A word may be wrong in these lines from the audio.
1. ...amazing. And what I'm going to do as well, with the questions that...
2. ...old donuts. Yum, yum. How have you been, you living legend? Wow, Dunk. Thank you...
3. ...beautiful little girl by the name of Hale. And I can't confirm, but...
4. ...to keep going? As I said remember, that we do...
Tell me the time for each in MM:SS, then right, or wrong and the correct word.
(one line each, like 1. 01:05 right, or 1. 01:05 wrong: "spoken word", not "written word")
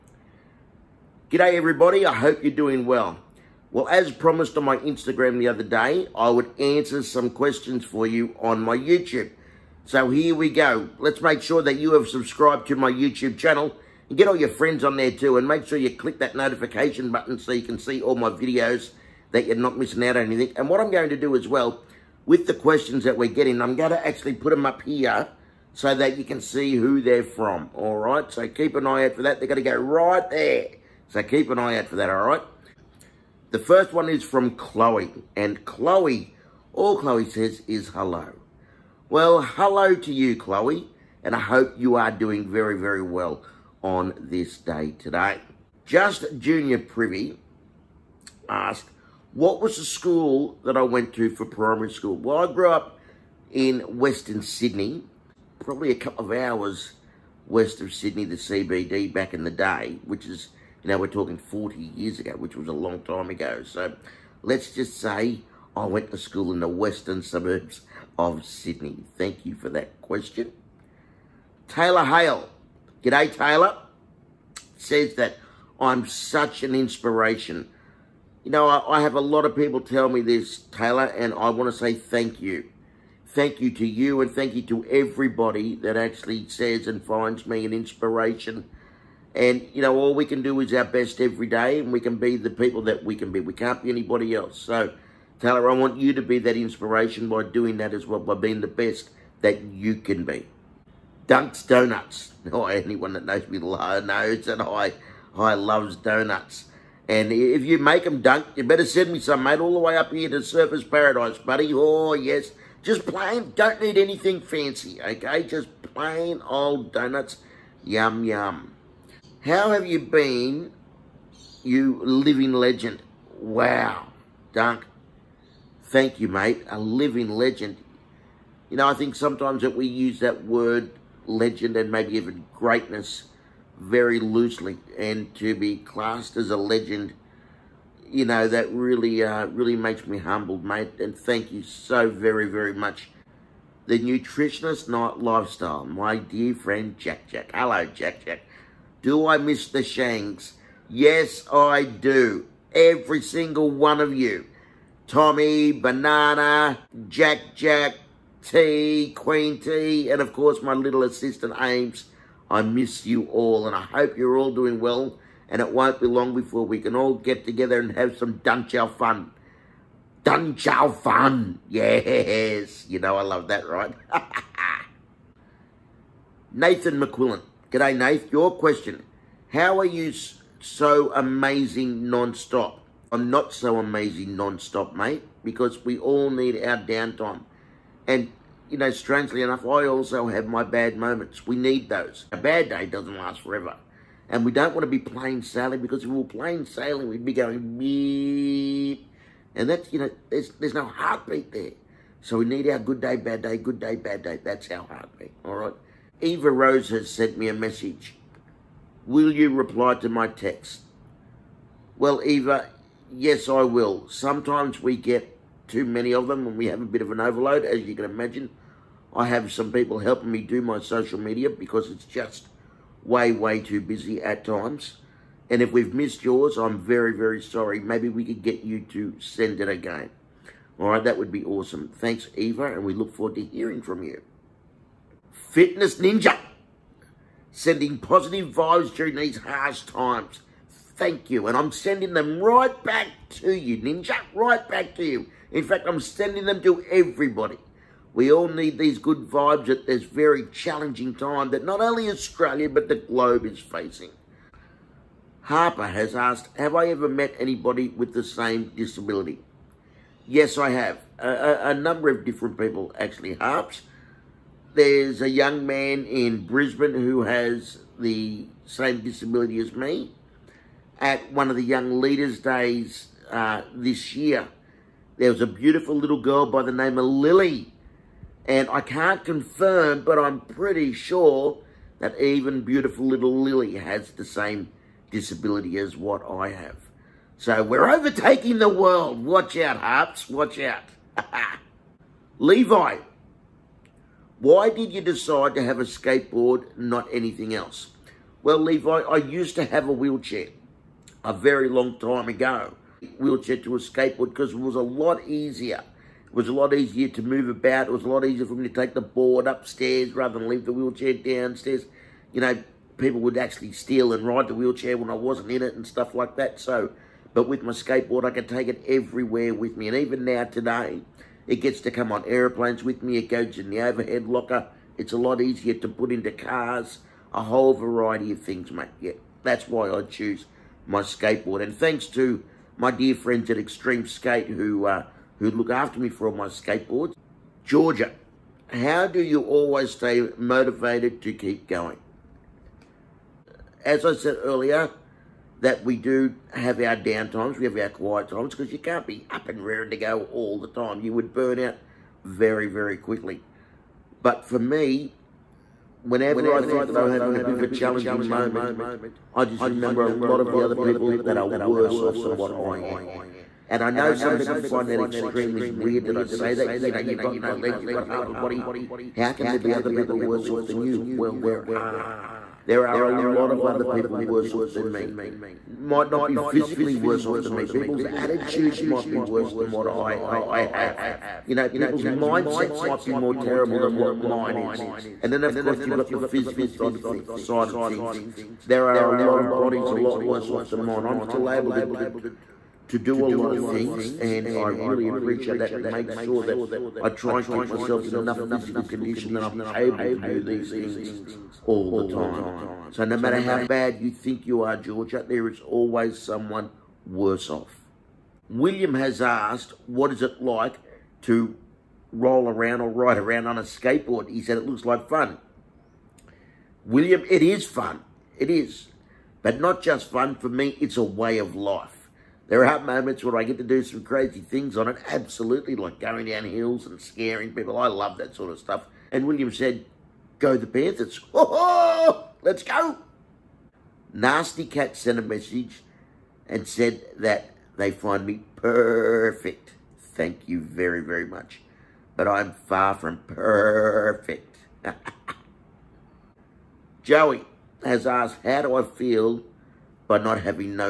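1. 00:20 wrong: "anything", not "amazing"
2. 01:56 right
3. 04:35 wrong: "Lily", not "Hale"
4. 05:41 wrong: "earlier", not "remember".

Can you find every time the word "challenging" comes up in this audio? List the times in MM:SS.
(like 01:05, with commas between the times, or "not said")
04:10, 05:57.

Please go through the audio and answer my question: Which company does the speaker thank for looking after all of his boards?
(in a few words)
Extreme Skate.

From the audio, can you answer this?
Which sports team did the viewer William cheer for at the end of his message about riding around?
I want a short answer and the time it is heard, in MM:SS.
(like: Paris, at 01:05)
Panthers, at 07:10.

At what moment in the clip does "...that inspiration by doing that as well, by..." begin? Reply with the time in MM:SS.
01:36.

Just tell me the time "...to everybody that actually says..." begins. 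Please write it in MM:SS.
01:24.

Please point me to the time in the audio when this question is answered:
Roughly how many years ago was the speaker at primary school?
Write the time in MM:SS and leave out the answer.
01:01.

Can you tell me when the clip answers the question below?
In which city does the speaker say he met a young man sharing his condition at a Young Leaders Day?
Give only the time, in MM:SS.
04:26.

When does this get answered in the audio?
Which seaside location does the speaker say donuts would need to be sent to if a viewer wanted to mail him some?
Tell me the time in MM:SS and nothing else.
01:50.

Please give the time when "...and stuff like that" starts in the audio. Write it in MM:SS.
05:15.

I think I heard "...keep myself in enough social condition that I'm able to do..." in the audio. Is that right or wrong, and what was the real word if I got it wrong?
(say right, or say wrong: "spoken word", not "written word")
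wrong: "physical", not "social".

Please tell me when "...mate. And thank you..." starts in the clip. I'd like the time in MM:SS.
02:20.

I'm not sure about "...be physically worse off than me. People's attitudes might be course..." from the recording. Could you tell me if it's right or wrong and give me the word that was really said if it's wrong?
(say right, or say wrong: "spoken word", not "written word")
wrong: "worse", not "course".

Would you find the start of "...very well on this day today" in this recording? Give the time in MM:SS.
00:42.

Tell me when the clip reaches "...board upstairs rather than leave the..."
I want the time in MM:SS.
05:09.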